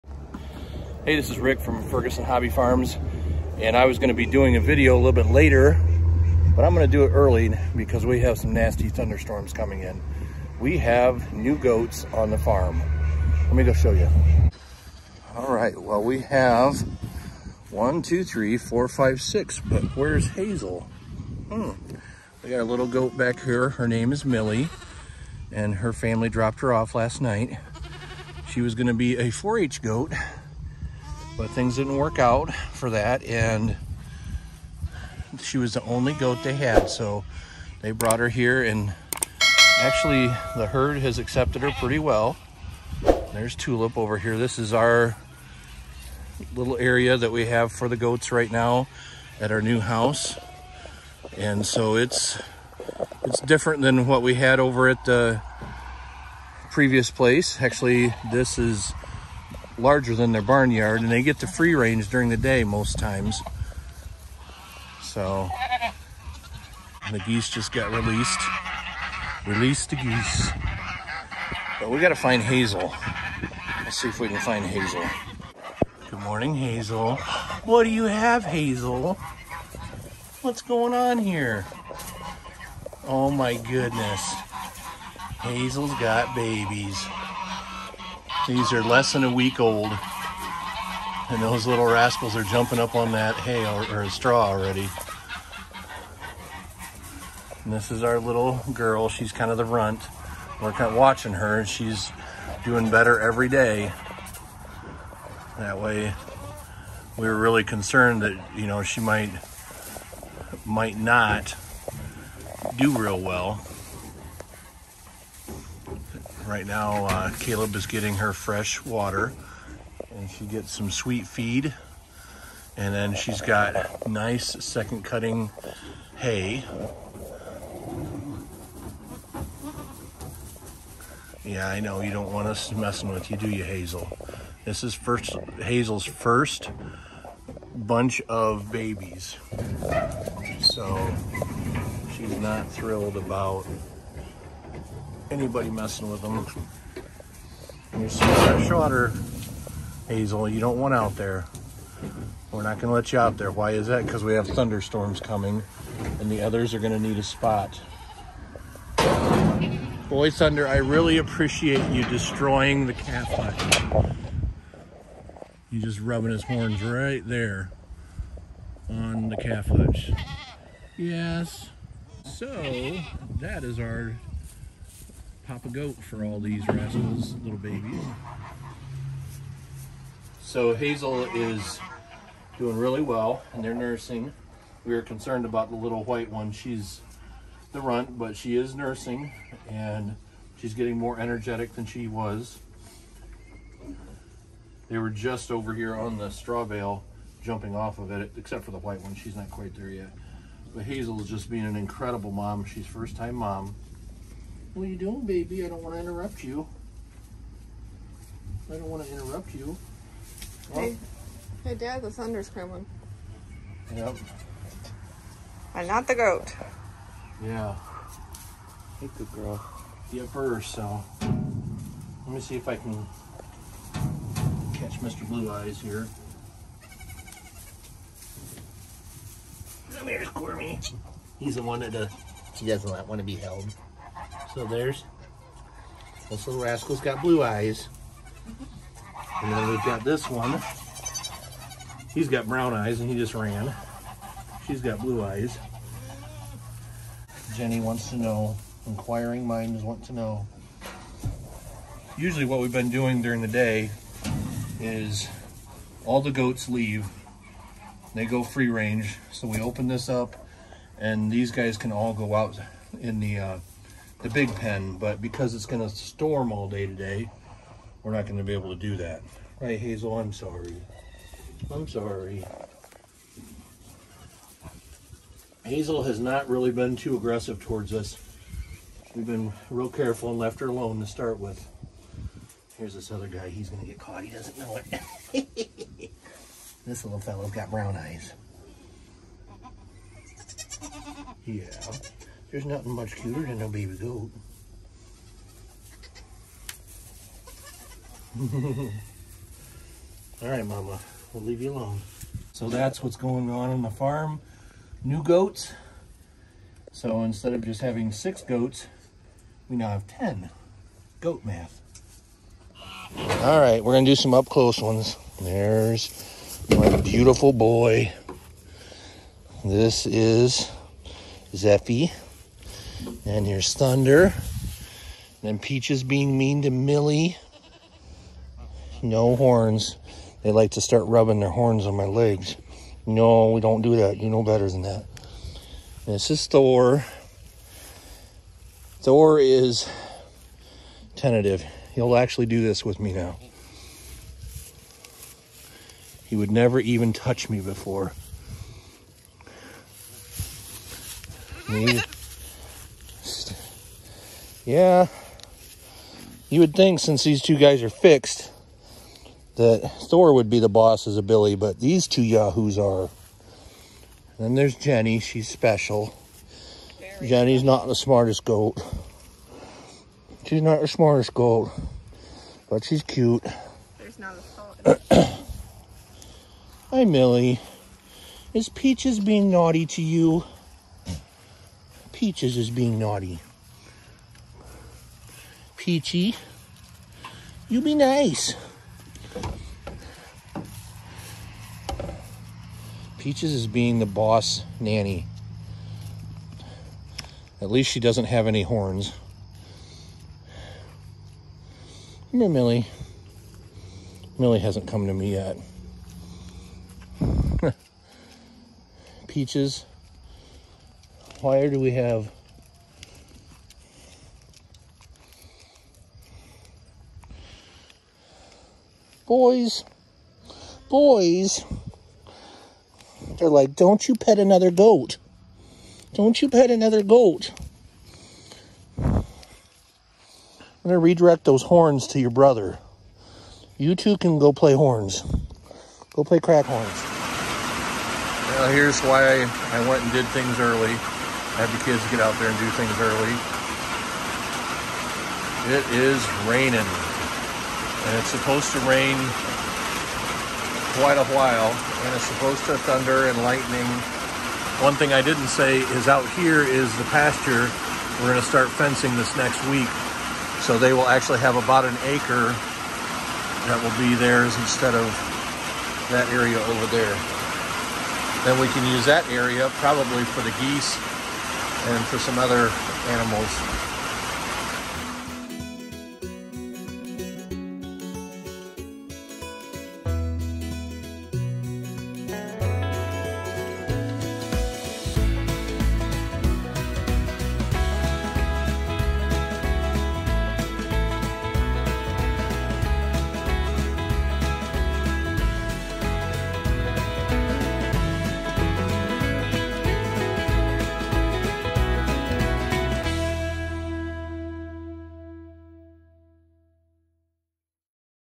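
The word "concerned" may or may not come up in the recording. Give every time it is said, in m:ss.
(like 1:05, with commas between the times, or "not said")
1:47, 3:05.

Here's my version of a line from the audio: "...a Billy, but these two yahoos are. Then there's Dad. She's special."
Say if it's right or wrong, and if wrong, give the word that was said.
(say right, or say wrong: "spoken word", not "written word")
wrong: "Jenny", not "Dad".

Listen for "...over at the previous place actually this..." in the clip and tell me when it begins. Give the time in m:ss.
0:54.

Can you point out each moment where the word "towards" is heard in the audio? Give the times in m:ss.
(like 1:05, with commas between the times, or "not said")
4:37.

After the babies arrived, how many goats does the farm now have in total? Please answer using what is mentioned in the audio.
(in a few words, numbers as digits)
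10.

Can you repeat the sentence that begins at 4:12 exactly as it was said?
Usually what we've been doing during the day is all the goats leave.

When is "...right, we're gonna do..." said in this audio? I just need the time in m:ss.
5:13.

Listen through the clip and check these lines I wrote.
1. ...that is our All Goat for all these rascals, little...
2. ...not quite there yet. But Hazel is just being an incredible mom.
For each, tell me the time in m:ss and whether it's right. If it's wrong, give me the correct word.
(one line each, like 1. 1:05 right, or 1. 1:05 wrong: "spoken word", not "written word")
1. 2:53 wrong: "Papa", not "All"
2. 3:19 right.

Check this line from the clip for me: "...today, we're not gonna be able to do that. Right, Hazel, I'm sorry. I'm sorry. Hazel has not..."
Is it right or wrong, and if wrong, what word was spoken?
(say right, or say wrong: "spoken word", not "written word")
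right.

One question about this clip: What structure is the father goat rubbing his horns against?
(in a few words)
calf hutch.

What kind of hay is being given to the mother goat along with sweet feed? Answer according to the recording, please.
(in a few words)
second cutting hay.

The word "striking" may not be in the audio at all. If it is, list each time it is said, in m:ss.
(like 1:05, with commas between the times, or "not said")
not said.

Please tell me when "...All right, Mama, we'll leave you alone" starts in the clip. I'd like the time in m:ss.
5:00.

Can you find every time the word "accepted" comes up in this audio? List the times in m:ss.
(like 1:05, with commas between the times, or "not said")
0:41.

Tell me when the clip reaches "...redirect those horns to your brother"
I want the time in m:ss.
7:10.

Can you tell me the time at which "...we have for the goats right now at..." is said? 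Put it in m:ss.
0:47.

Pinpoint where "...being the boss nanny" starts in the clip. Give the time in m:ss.
6:33.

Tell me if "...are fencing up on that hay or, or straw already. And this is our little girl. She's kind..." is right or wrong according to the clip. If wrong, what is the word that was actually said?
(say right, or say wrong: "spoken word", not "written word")
wrong: "jumping", not "fencing".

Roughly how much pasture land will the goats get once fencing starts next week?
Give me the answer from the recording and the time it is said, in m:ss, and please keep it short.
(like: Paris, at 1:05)
about an acre, at 7:41.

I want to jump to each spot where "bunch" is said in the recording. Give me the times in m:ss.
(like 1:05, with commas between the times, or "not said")
2:17.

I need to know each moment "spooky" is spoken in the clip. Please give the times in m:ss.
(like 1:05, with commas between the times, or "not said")
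not said.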